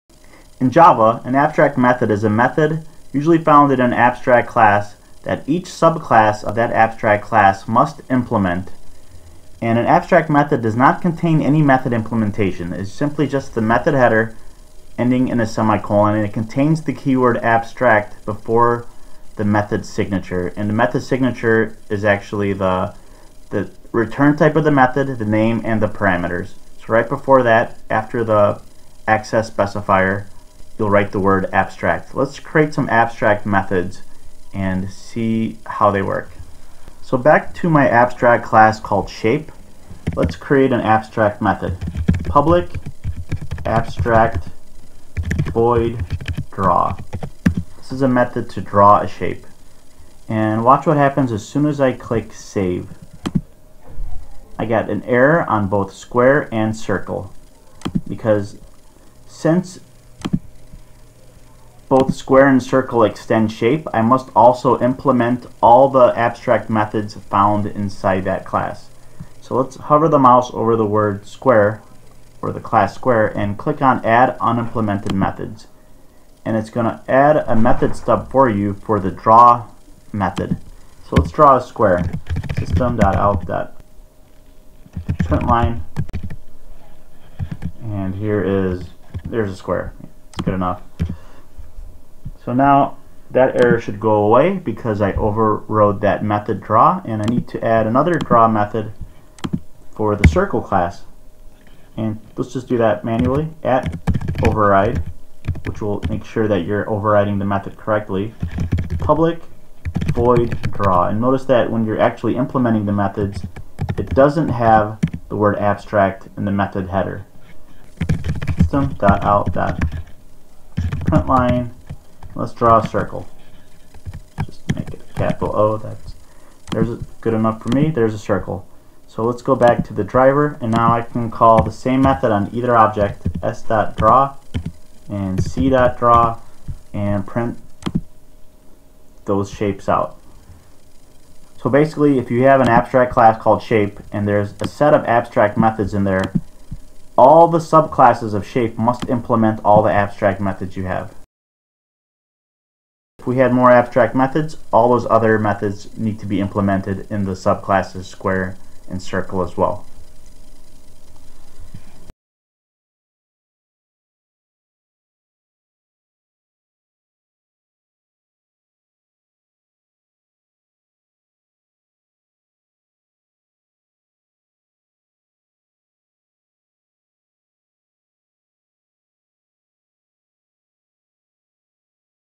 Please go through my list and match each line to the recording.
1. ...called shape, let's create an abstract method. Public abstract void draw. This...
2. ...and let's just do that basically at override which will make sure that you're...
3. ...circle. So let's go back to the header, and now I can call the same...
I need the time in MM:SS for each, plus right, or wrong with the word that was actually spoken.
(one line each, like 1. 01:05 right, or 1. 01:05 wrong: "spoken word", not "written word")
1. 00:38 right
2. 01:41 wrong: "manually", not "basically"
3. 02:08 wrong: "driver", not "header".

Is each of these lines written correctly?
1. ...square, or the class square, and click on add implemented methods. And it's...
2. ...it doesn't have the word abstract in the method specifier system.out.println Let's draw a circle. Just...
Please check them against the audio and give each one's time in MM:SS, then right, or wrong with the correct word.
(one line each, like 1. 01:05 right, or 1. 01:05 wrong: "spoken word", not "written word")
1. 01:11 wrong: "unimplemented", not "implemented"
2. 01:53 wrong: "header", not "specifier".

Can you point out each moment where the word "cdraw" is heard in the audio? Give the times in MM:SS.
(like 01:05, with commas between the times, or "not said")
02:15.